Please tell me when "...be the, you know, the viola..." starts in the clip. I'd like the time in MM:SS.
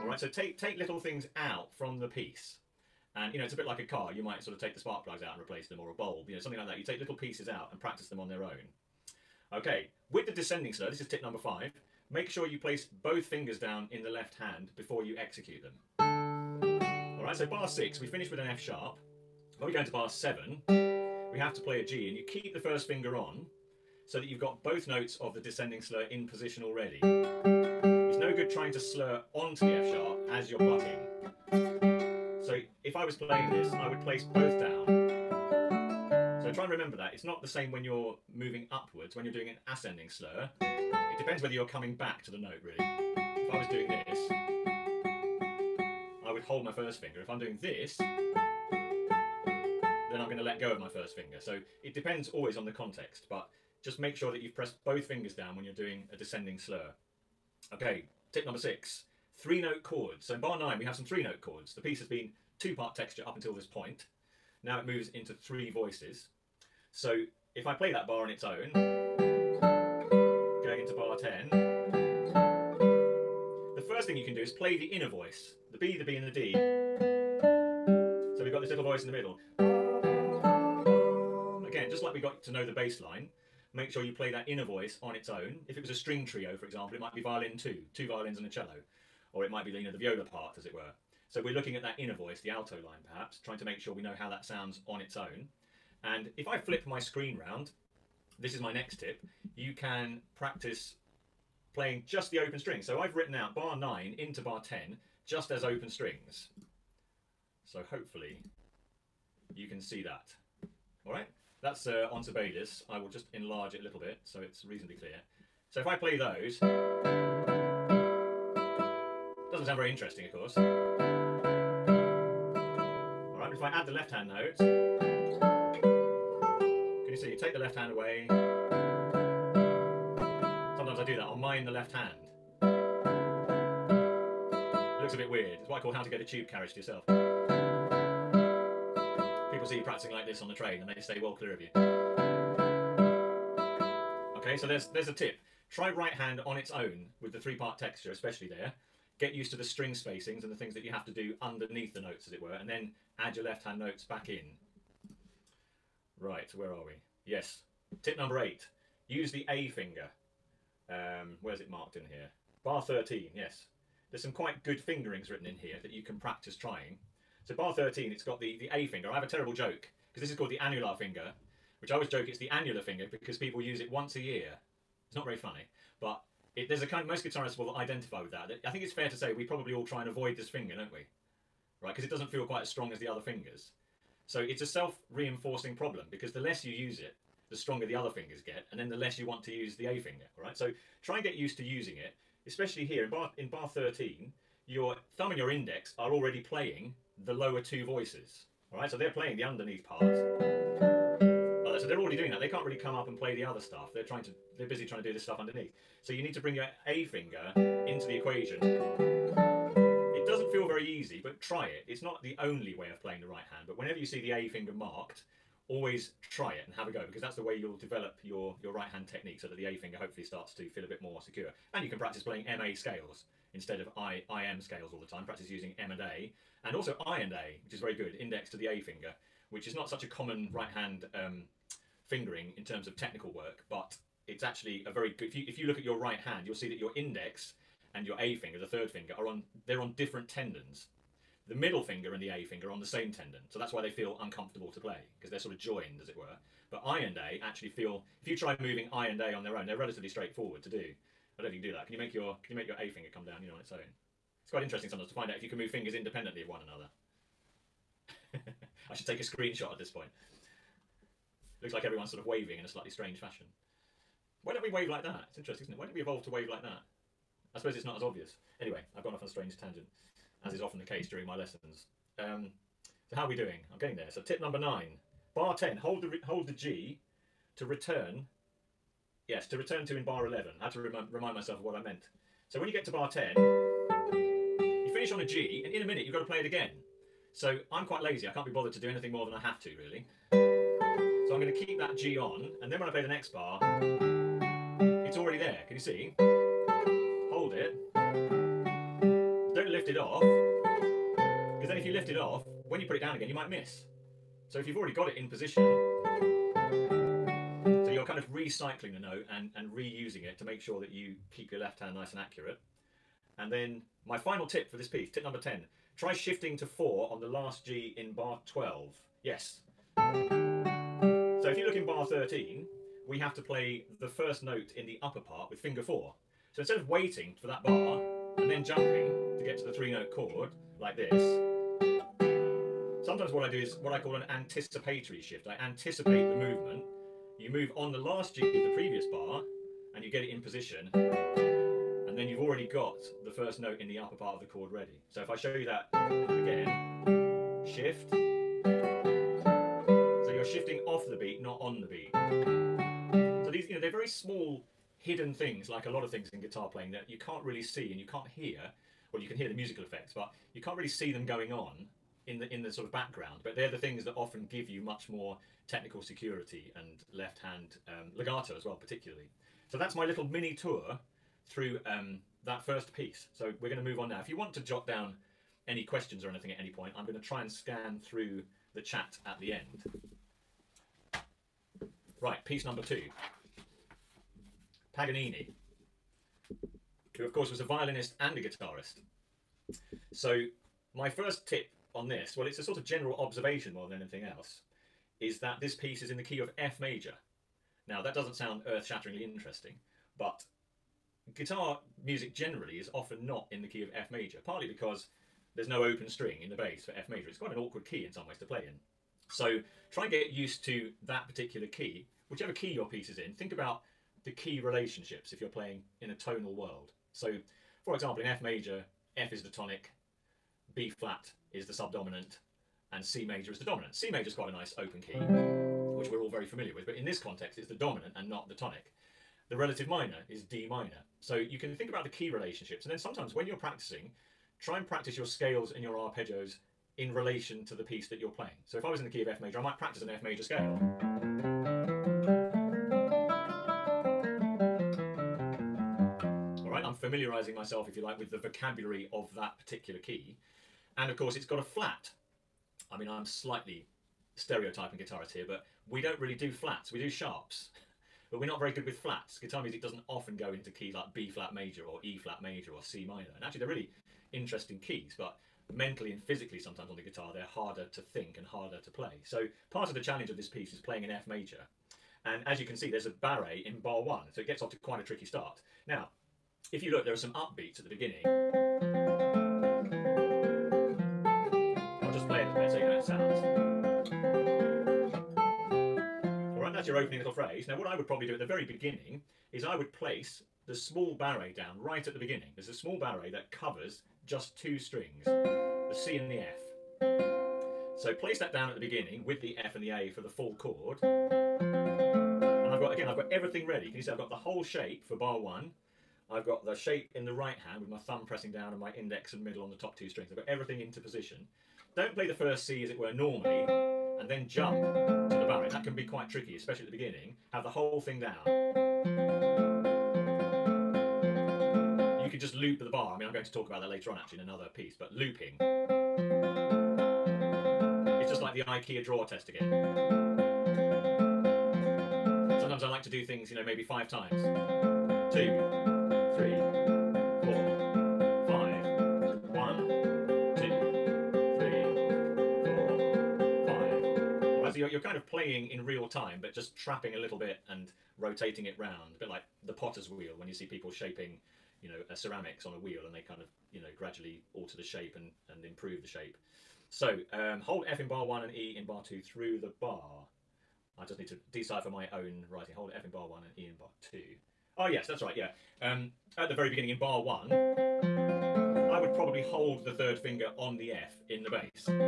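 01:29.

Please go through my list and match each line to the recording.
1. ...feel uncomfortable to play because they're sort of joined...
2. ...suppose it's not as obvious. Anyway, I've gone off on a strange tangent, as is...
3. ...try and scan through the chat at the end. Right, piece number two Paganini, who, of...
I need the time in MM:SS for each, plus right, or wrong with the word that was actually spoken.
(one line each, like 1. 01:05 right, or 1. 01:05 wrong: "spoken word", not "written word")
1. 04:03 right
2. 04:27 right
3. 06:17 right.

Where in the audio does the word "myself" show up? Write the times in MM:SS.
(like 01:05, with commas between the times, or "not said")
04:41, 07:27.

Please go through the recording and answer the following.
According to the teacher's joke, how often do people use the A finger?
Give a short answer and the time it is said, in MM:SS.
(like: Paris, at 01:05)
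once a year, at 02:53.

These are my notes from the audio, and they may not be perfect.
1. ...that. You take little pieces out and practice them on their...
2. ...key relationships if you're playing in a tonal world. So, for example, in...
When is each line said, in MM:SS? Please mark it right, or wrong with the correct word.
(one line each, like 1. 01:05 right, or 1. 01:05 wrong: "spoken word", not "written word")
1. 00:06 right
2. 06:54 right.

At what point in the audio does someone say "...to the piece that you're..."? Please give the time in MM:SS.
07:17.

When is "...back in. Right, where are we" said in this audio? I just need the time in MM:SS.
02:34.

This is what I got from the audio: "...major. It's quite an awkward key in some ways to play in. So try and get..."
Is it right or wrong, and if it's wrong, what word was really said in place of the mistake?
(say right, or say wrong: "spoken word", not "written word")
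right.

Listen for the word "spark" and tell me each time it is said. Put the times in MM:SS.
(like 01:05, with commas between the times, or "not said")
00:04.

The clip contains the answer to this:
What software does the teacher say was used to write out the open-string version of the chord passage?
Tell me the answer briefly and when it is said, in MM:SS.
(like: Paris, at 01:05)
Sibelius, at 01:52.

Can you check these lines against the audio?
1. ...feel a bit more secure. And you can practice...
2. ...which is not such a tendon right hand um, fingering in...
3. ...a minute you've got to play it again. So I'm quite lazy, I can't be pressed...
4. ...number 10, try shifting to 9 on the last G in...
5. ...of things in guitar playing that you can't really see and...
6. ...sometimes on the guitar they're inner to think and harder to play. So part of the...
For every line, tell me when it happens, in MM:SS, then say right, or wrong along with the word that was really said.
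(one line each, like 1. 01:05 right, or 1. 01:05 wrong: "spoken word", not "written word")
1. 03:40 right
2. 03:49 wrong: "common", not "tendon"
3. 04:45 wrong: "bothered", not "pressed"
4. 05:15 wrong: "4", not "9"
5. 05:56 right
6. 07:46 wrong: "harder", not "inner".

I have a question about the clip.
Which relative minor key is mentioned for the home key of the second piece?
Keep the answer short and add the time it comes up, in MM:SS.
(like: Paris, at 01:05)
D minor, at 07:10.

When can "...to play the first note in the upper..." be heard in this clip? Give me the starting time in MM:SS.
05:23.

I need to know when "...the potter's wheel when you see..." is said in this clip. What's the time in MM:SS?
09:09.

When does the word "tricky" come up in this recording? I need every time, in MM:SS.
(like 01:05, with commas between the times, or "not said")
07:55, 08:36.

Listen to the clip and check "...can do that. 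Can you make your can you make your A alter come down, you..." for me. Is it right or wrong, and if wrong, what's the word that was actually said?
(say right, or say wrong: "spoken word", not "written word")
wrong: "finger", not "alter".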